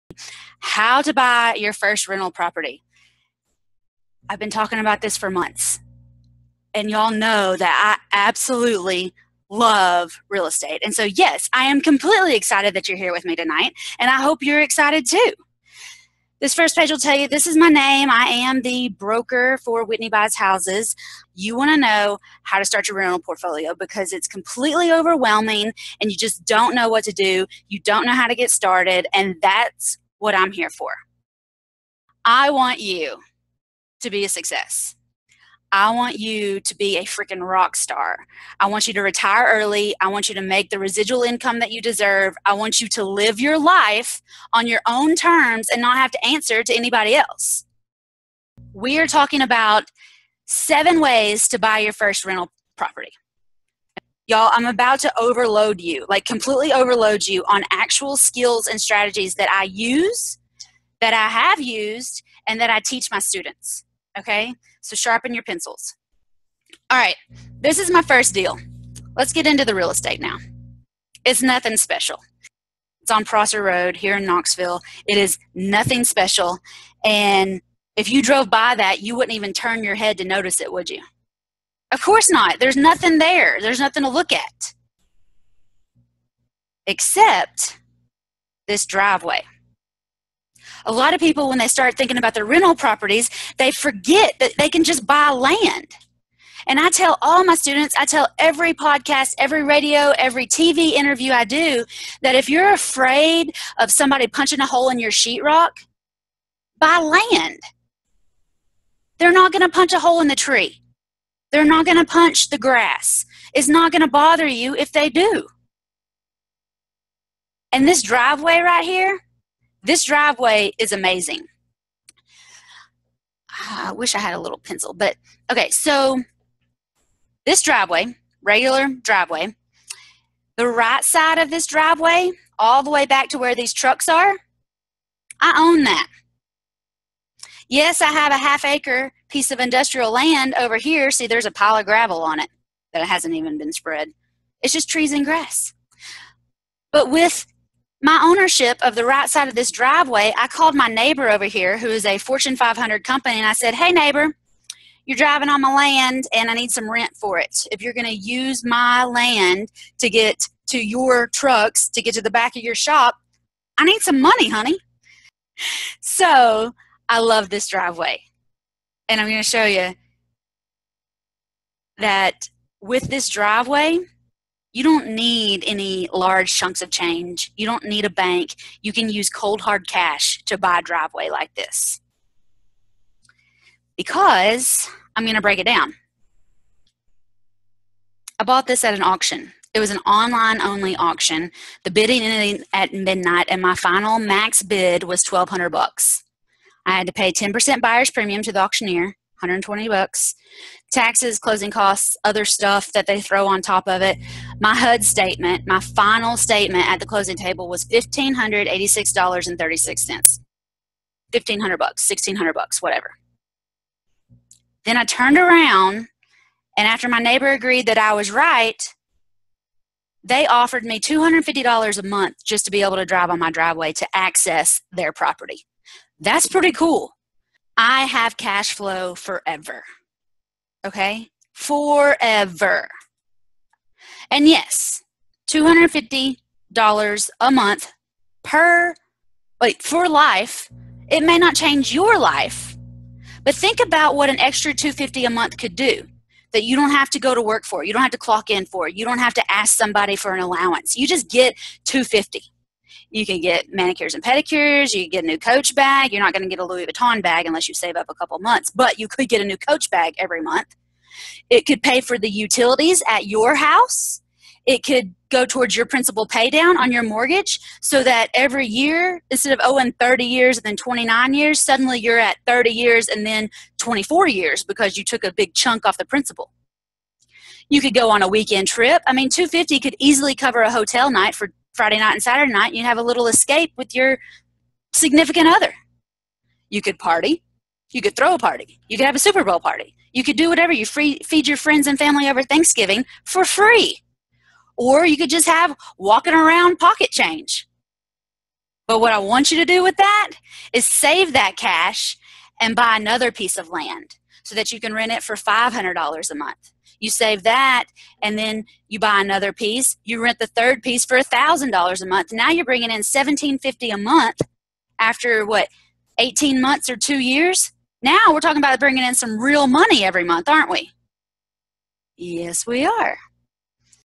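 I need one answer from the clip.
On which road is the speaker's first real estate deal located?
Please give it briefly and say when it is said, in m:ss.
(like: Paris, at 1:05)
Prosser Road, at 1:13.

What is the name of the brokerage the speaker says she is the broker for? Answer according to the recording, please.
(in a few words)
Whitney Buys Houses.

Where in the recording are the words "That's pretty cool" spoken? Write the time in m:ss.
3:46.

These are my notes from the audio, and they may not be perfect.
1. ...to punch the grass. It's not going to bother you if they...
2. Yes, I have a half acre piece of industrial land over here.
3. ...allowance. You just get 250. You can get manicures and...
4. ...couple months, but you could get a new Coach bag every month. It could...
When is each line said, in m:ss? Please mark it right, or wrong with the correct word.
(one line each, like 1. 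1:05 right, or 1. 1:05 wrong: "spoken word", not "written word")
1. 1:51 right
2. 2:17 right
3. 4:10 right
4. 4:18 right.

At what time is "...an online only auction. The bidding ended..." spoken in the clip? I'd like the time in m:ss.
3:09.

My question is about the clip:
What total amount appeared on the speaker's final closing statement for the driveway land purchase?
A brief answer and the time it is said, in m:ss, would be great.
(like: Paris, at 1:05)
$1,586.36, at 3:27.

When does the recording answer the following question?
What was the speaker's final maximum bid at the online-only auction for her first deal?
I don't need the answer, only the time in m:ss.
3:15.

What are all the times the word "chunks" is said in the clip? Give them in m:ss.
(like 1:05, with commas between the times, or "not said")
2:56, 4:35.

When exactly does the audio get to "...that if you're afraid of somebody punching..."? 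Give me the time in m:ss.
1:42.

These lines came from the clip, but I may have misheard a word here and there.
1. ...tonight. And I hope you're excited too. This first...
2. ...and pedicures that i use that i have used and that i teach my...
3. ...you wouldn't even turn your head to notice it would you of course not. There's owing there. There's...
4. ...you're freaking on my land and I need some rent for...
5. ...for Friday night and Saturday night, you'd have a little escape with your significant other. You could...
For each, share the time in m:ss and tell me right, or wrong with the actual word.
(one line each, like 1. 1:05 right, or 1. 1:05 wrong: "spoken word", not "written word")
1. 0:13 right
2. 0:58 wrong: "strategies", not "pedicures"
3. 1:19 wrong: "nothing", not "owing"
4. 2:35 wrong: "driving", not "freaking"
5. 4:41 right.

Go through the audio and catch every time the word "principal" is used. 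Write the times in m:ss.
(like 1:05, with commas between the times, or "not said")
4:25, 4:36.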